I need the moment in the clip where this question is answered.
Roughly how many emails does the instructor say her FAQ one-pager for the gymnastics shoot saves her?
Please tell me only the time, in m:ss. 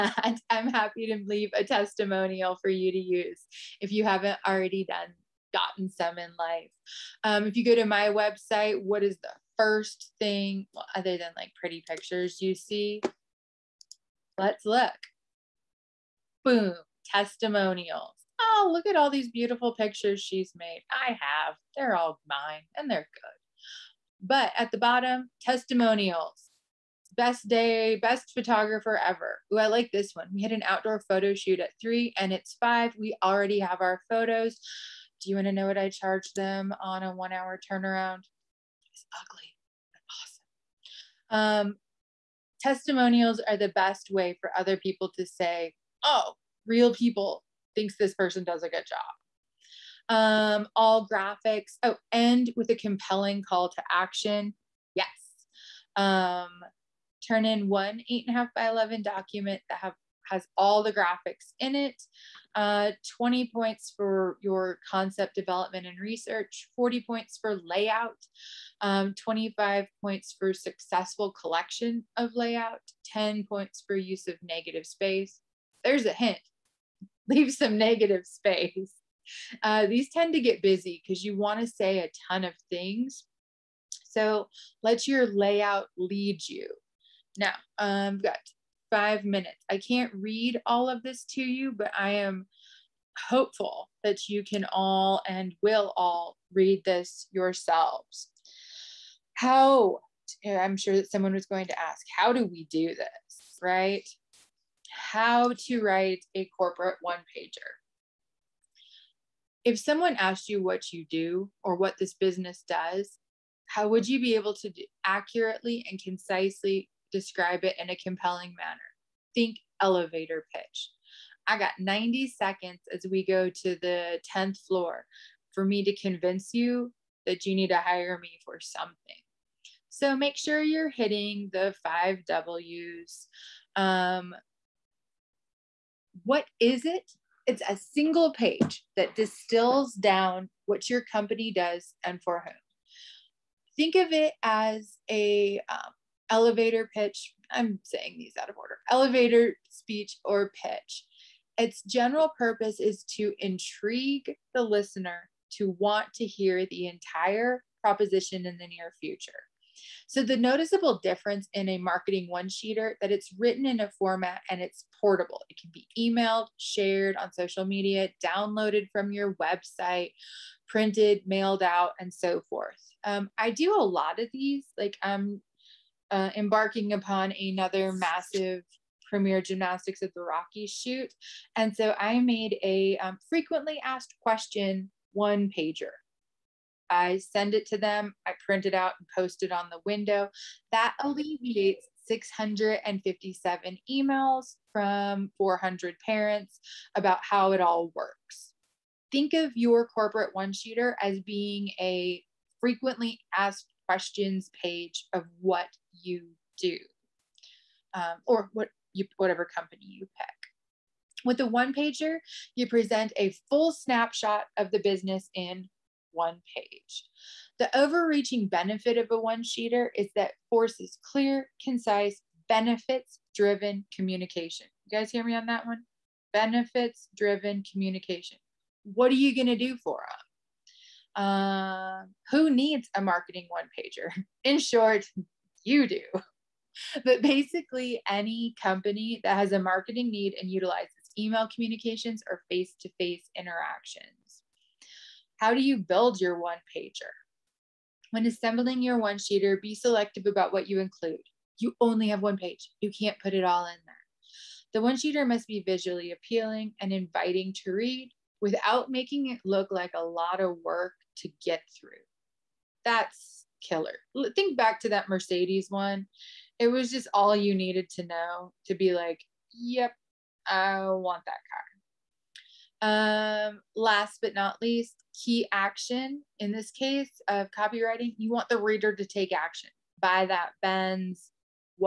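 3:12.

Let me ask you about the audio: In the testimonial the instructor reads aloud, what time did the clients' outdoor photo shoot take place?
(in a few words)
3.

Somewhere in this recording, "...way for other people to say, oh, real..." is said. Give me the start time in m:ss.
0:44.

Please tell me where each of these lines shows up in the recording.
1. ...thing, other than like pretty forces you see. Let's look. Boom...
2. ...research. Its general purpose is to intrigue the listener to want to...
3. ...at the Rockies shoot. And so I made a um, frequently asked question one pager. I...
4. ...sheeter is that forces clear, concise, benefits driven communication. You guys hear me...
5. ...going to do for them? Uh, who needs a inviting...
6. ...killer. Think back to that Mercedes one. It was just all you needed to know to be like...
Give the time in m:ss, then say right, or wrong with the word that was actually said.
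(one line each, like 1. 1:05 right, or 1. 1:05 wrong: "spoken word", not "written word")
1. 0:10 wrong: "pictures", not "forces"
2. 2:30 wrong: "pitch", not "research"
3. 3:00 right
4. 3:39 right
5. 3:49 wrong: "marketing", not "inviting"
6. 4:23 right.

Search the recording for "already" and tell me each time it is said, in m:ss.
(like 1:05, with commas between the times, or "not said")
0:04, 0:33.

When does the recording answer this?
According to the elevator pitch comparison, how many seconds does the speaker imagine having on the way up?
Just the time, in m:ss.
2:01.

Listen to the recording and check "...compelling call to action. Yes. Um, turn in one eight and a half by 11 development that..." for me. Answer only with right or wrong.
wrong.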